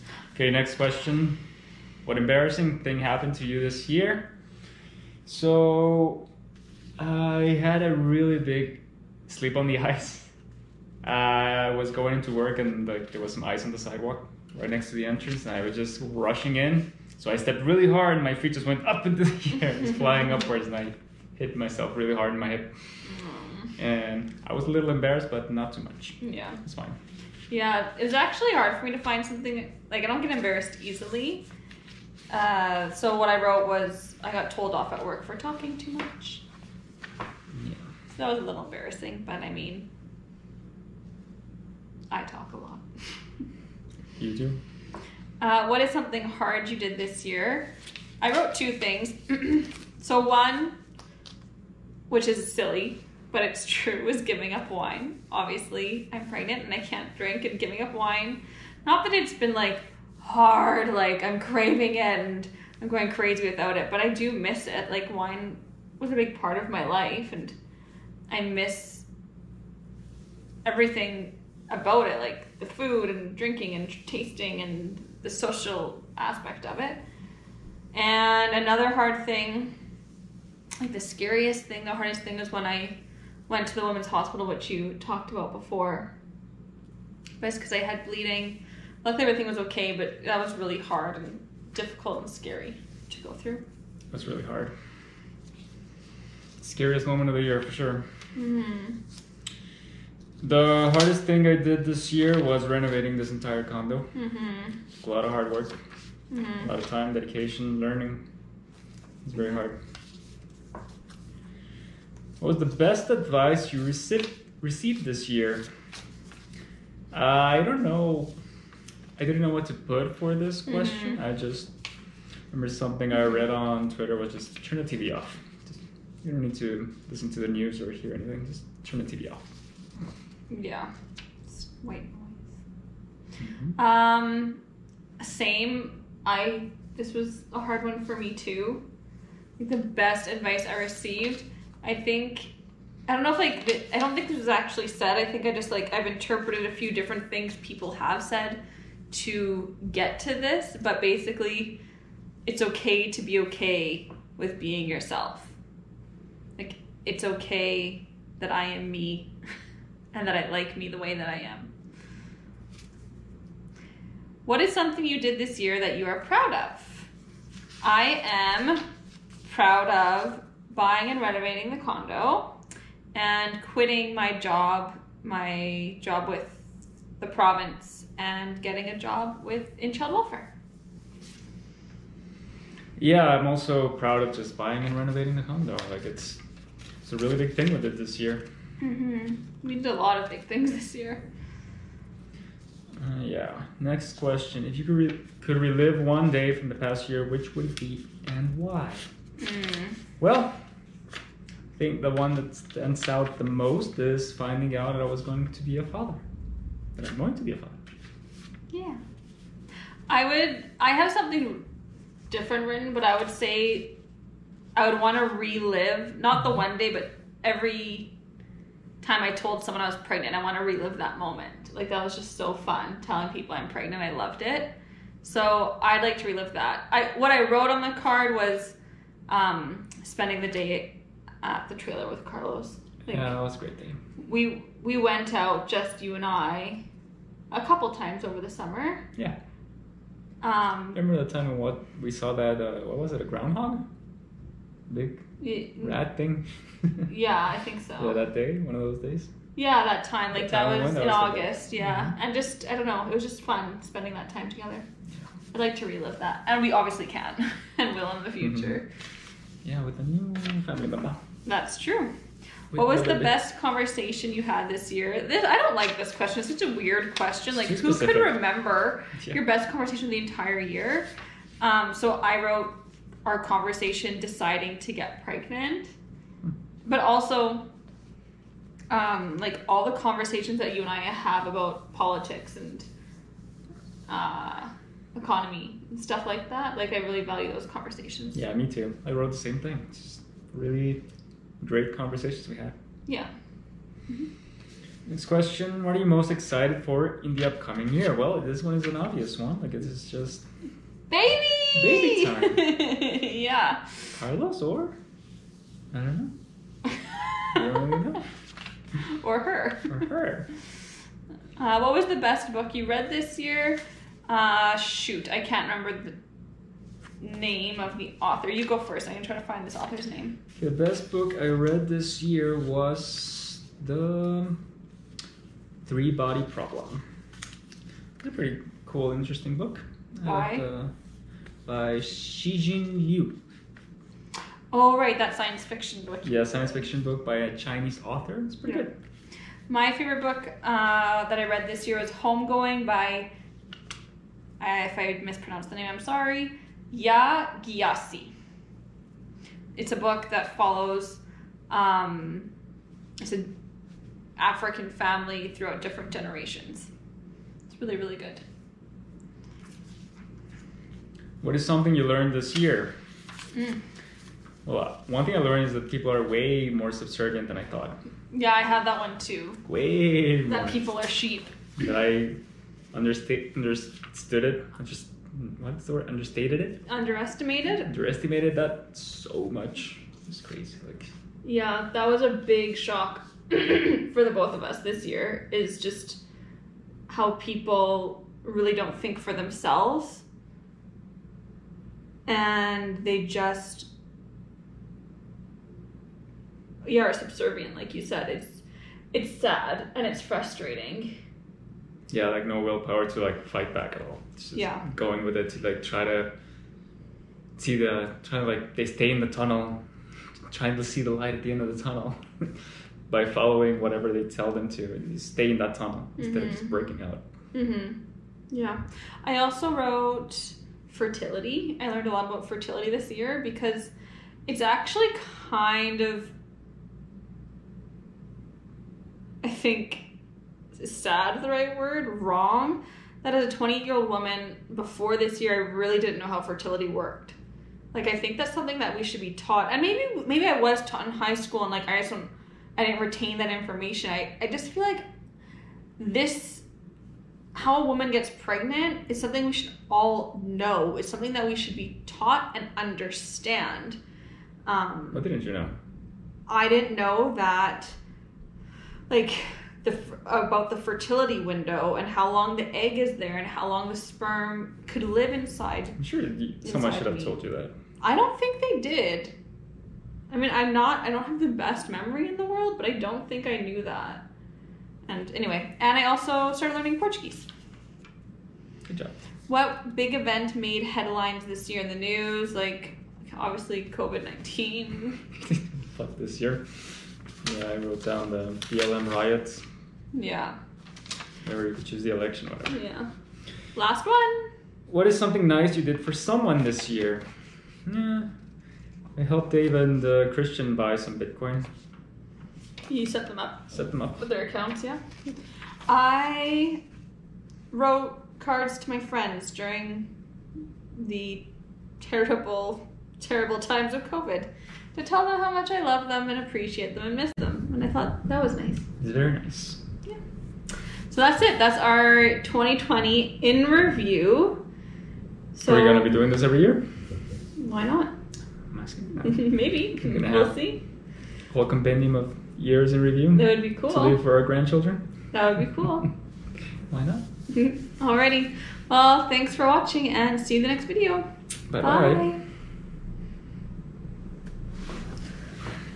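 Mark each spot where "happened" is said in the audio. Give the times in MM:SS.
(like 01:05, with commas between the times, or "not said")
00:02.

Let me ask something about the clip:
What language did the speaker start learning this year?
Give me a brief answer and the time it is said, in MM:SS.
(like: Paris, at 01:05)
Portuguese, at 07:56.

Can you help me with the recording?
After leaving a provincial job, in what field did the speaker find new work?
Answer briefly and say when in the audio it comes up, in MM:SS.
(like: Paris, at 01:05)
Child welfare, at 02:59.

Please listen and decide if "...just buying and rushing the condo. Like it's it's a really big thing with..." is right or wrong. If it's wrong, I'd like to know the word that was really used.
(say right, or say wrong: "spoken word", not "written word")
wrong: "renovating", not "rushing".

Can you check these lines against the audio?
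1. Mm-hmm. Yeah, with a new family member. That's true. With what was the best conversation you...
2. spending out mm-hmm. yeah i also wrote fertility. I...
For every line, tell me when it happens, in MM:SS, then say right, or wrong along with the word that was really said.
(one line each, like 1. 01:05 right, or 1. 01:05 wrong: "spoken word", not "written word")
1. 04:18 right
2. 06:56 wrong: "breaking", not "spending".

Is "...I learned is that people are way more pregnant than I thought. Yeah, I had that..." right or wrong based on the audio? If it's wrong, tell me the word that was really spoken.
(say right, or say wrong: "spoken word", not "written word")
wrong: "subservient", not "pregnant".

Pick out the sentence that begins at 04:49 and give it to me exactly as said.
It's just really great conversations we had.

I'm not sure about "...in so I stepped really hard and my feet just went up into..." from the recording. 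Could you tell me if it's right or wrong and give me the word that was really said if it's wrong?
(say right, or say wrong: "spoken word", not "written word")
right.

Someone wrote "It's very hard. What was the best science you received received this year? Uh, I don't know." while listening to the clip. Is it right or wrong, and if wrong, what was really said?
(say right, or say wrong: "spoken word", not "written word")
wrong: "advice", not "science".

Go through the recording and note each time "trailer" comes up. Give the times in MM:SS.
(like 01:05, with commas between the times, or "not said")
03:51.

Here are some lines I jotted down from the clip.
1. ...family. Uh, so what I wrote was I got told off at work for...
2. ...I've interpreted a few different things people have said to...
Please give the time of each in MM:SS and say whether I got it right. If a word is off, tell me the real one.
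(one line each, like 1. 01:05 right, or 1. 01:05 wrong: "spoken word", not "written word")
1. 00:30 wrong: "easily", not "family"
2. 02:25 right.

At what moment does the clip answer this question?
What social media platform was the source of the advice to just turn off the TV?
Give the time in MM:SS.
02:03.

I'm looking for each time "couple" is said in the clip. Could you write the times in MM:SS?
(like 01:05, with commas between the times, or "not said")
03:57.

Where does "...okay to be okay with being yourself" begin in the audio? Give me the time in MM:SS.
02:32.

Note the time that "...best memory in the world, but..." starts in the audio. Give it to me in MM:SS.
07:51.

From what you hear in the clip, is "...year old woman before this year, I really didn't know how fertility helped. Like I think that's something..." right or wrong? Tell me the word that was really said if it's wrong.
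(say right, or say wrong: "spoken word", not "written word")
wrong: "worked", not "helped".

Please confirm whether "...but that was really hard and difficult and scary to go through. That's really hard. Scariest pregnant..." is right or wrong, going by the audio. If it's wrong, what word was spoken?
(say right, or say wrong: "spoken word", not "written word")
wrong: "moment", not "pregnant".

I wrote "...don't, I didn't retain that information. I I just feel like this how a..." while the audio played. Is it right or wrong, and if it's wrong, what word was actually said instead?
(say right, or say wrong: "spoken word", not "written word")
right.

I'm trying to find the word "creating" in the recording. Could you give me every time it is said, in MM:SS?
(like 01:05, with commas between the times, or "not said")
not said.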